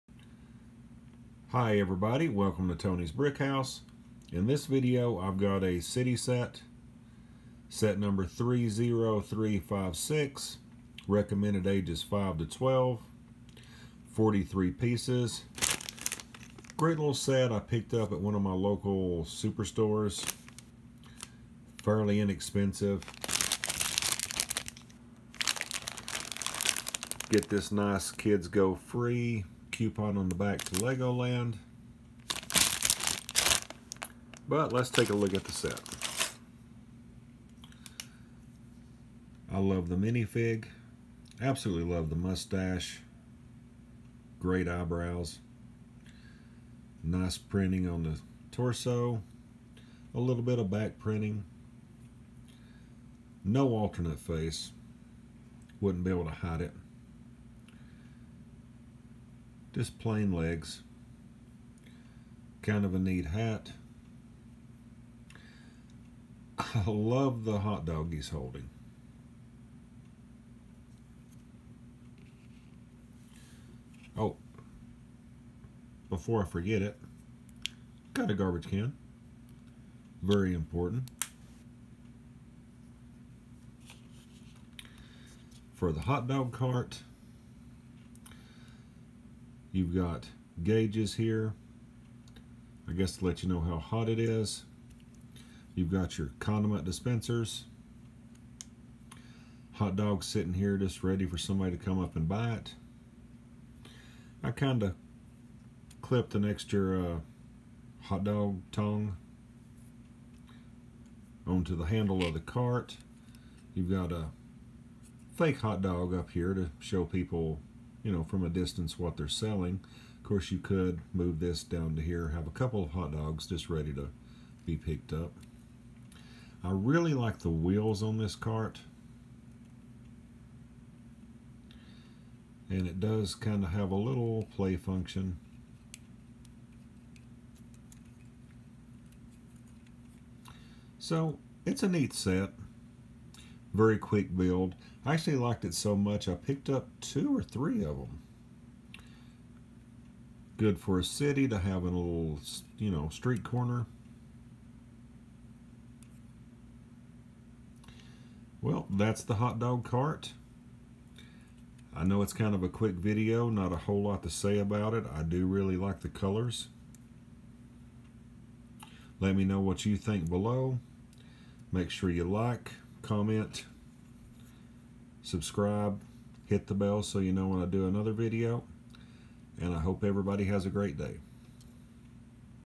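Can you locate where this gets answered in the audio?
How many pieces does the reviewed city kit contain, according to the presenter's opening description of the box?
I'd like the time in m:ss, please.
0:14.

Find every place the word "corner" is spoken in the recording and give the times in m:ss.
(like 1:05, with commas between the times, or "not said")
2:33.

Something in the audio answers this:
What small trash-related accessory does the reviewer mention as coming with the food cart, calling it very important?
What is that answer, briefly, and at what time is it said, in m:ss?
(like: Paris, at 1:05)
Garbage can, at 1:18.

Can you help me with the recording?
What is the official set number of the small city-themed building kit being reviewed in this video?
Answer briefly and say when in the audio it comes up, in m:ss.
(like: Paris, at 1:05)
30356, at 0:08.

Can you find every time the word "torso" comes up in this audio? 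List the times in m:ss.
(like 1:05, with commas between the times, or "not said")
0:48.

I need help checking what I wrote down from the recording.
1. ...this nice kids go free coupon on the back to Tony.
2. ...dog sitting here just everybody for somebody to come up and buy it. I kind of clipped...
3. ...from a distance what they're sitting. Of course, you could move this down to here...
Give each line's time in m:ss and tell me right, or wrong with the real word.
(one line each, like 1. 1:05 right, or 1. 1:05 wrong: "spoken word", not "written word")
1. 0:27 wrong: "Legoland", not "Tony"
2. 1:39 wrong: "ready", not "everybody"
3. 1:58 wrong: "selling", not "sitting".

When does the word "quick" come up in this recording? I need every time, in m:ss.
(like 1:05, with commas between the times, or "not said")
2:23, 2:42.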